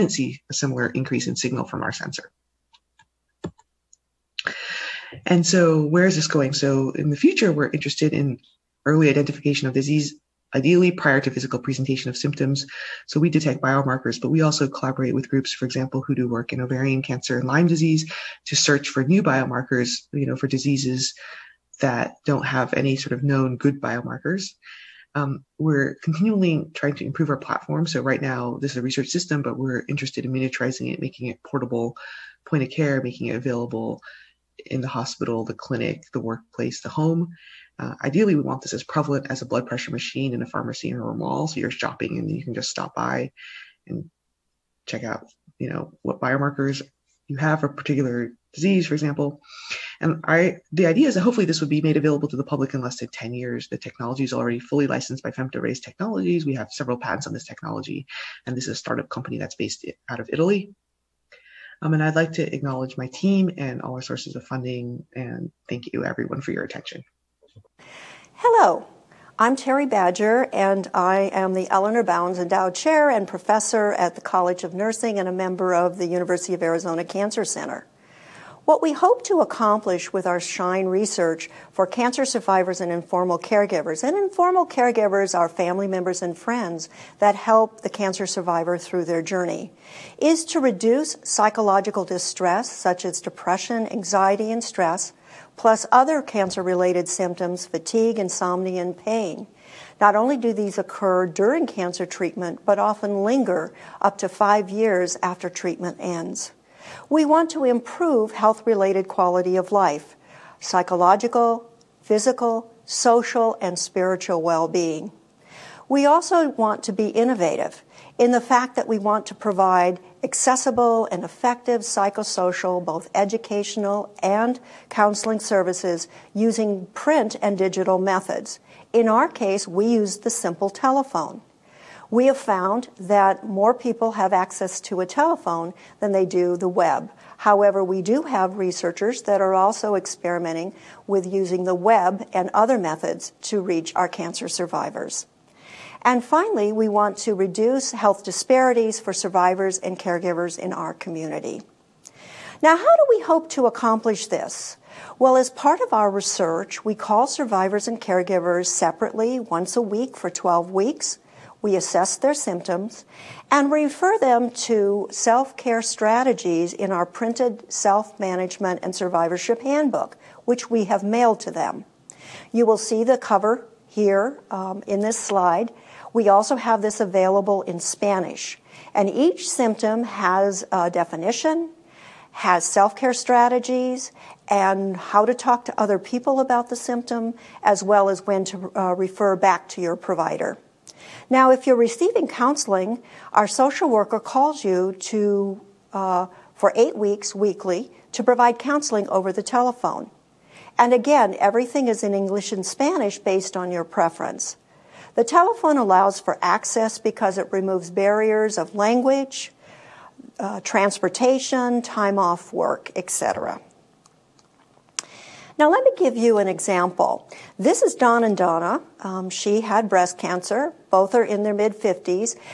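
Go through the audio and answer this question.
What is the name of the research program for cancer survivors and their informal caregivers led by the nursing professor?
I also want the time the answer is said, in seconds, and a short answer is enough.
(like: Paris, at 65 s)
SHINE, at 80 s.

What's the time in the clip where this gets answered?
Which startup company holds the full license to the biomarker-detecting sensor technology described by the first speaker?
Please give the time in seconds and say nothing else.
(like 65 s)
55 s.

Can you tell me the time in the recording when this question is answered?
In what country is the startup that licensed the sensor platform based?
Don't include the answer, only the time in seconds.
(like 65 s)
60 s.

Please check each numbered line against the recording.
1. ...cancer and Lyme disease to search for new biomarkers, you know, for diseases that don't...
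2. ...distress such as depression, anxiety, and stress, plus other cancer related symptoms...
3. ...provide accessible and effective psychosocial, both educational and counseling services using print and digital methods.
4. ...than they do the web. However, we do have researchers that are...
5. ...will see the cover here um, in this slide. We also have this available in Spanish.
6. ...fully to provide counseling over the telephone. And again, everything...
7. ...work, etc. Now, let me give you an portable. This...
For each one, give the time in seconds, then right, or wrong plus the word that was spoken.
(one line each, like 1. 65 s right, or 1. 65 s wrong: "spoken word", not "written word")
1. 17 s right
2. 92 s right
3. 119 s right
4. 135 s right
5. 172 s right
6. 197 s wrong: "weekly", not "fully"
7. 212 s wrong: "example", not "portable".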